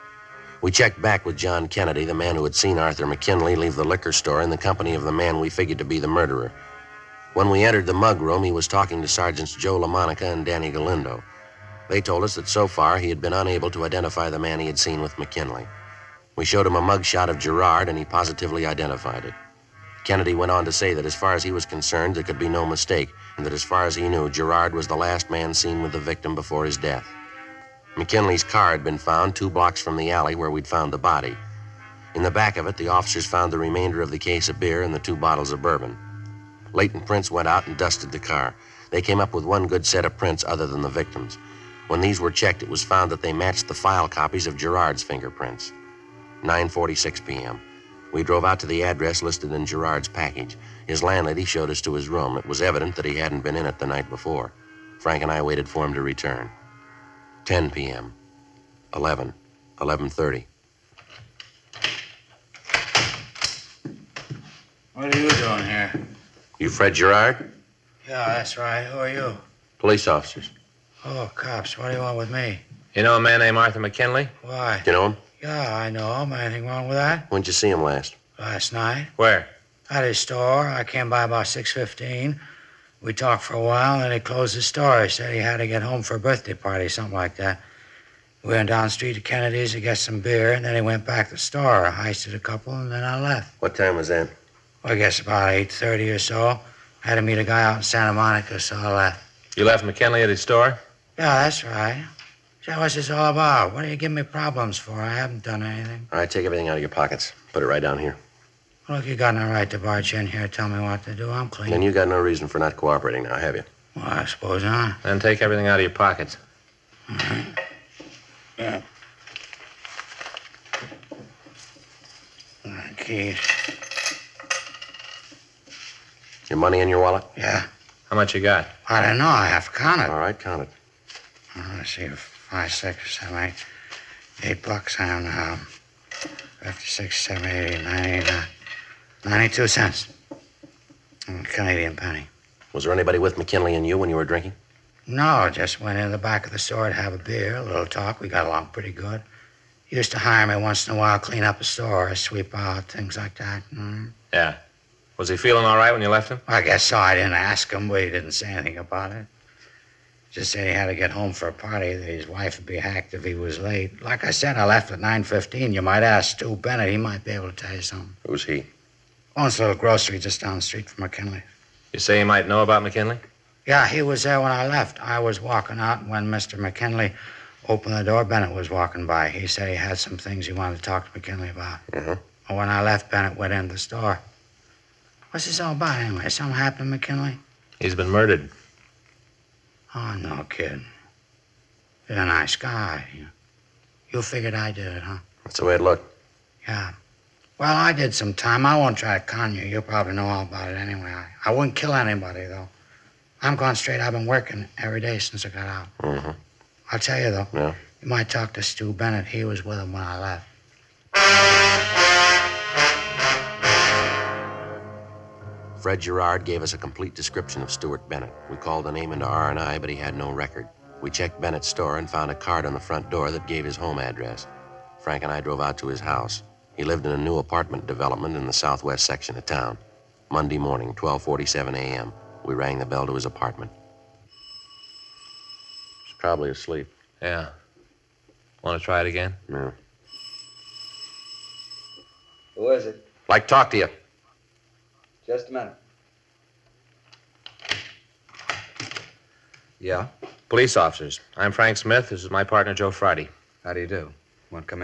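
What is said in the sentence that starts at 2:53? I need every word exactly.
Yeah, he was there when I left.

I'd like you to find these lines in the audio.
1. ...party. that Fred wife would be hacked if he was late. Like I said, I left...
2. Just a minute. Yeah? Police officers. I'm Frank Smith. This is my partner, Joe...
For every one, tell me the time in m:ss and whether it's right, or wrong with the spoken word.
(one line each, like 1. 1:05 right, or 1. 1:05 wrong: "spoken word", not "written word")
1. 2:41 wrong: "His", not "Fred"
2. 4:05 right.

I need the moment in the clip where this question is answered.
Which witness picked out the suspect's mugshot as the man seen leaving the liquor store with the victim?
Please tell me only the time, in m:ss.
0:01.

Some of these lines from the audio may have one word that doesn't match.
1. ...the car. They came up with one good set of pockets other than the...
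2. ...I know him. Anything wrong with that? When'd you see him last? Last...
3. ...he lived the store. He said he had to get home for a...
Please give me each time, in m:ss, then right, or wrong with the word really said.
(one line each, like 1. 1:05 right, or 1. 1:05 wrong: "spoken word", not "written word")
1. 0:38 wrong: "prints", not "pockets"
2. 1:15 right
3. 1:24 wrong: "closed", not "lived".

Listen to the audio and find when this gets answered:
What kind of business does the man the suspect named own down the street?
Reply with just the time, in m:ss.
2:49.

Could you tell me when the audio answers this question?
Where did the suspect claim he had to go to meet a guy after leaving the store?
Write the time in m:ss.
1:37.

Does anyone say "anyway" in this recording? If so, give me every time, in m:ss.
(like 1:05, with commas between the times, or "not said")
3:05, 3:20.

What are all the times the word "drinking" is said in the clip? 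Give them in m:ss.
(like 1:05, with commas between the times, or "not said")
2:24.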